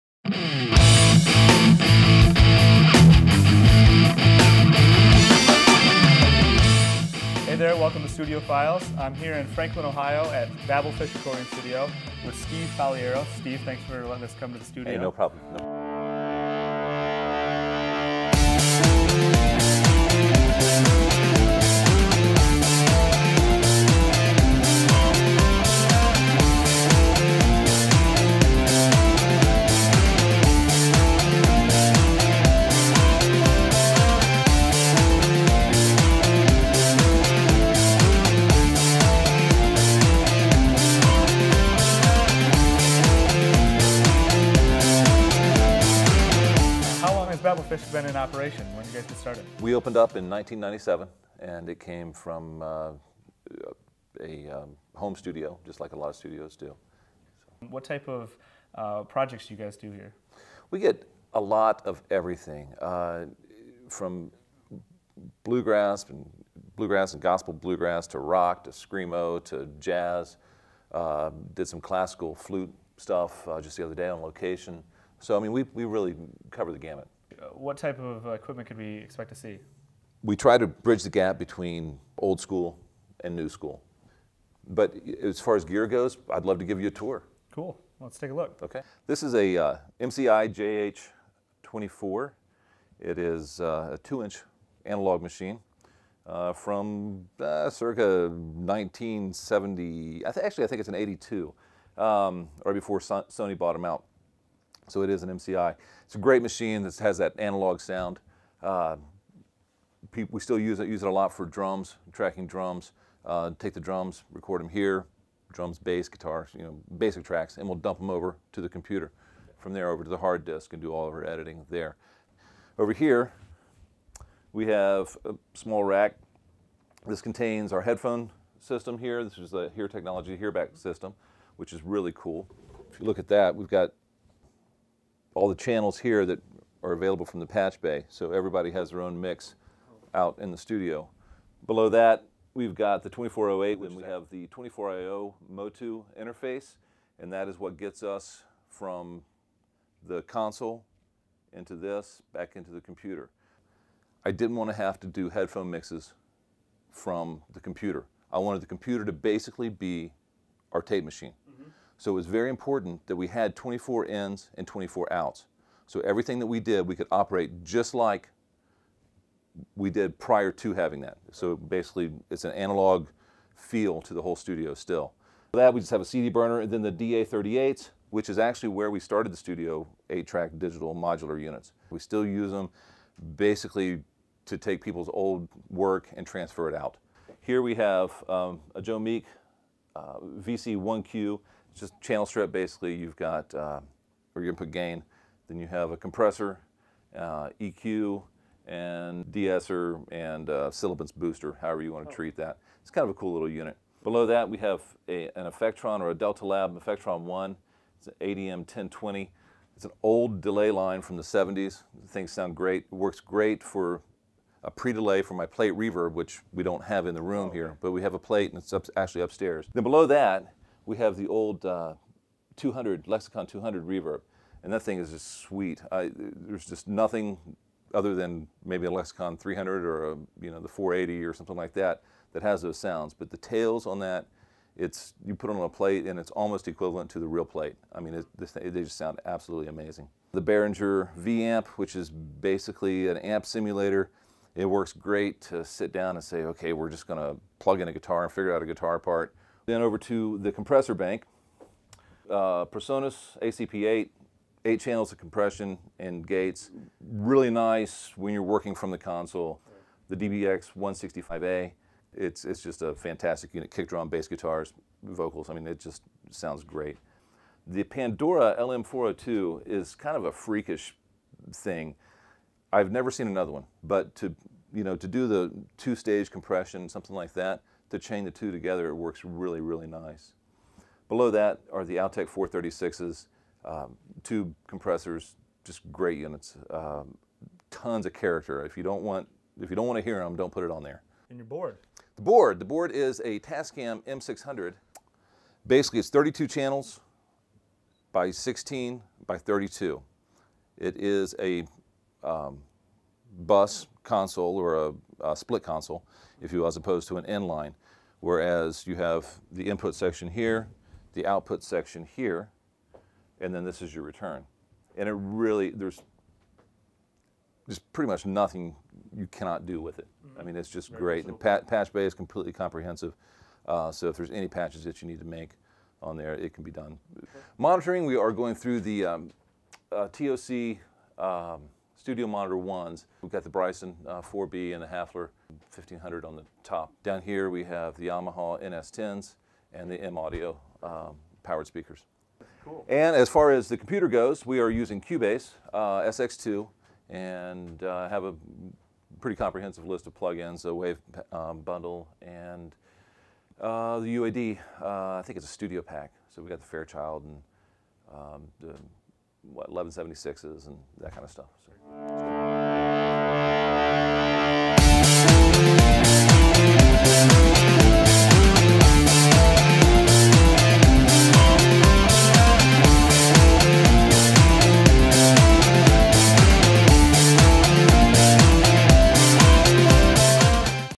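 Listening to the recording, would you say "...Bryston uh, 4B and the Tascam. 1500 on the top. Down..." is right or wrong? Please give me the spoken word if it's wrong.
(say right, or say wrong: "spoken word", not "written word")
wrong: "Hafler", not "Tascam".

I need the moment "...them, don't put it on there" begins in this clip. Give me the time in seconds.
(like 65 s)
290 s.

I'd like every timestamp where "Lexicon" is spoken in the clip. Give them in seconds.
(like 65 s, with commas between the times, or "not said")
223 s, 228 s.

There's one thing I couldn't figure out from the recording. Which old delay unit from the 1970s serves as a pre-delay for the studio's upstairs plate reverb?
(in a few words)
Delta Lab Effectron 1.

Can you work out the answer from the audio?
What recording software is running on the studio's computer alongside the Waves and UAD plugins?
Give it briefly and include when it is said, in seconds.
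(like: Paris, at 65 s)
Cubase SX2, at 345 s.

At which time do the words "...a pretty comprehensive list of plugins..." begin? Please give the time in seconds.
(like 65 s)
348 s.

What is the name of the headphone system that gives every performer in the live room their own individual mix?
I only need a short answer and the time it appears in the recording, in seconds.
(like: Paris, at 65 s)
Hearback, at 130 s.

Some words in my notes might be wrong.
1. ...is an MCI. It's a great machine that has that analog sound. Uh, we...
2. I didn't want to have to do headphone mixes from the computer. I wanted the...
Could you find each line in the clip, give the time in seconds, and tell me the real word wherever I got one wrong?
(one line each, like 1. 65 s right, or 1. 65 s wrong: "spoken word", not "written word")
1. 105 s right
2. 154 s right.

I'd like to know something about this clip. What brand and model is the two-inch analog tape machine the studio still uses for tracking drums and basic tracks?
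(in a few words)
MCI JH24.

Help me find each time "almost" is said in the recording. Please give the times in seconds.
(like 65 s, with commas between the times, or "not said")
236 s.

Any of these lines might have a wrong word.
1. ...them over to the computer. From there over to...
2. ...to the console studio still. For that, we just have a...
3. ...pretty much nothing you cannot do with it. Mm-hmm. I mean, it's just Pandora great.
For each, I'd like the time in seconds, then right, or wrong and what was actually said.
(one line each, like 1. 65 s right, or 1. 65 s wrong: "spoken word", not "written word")
1. 117 s right
2. 174 s wrong: "whole", not "console"
3. 317 s wrong: "Very", not "Pandora".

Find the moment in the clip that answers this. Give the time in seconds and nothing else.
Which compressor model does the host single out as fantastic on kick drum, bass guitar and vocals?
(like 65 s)
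260 s.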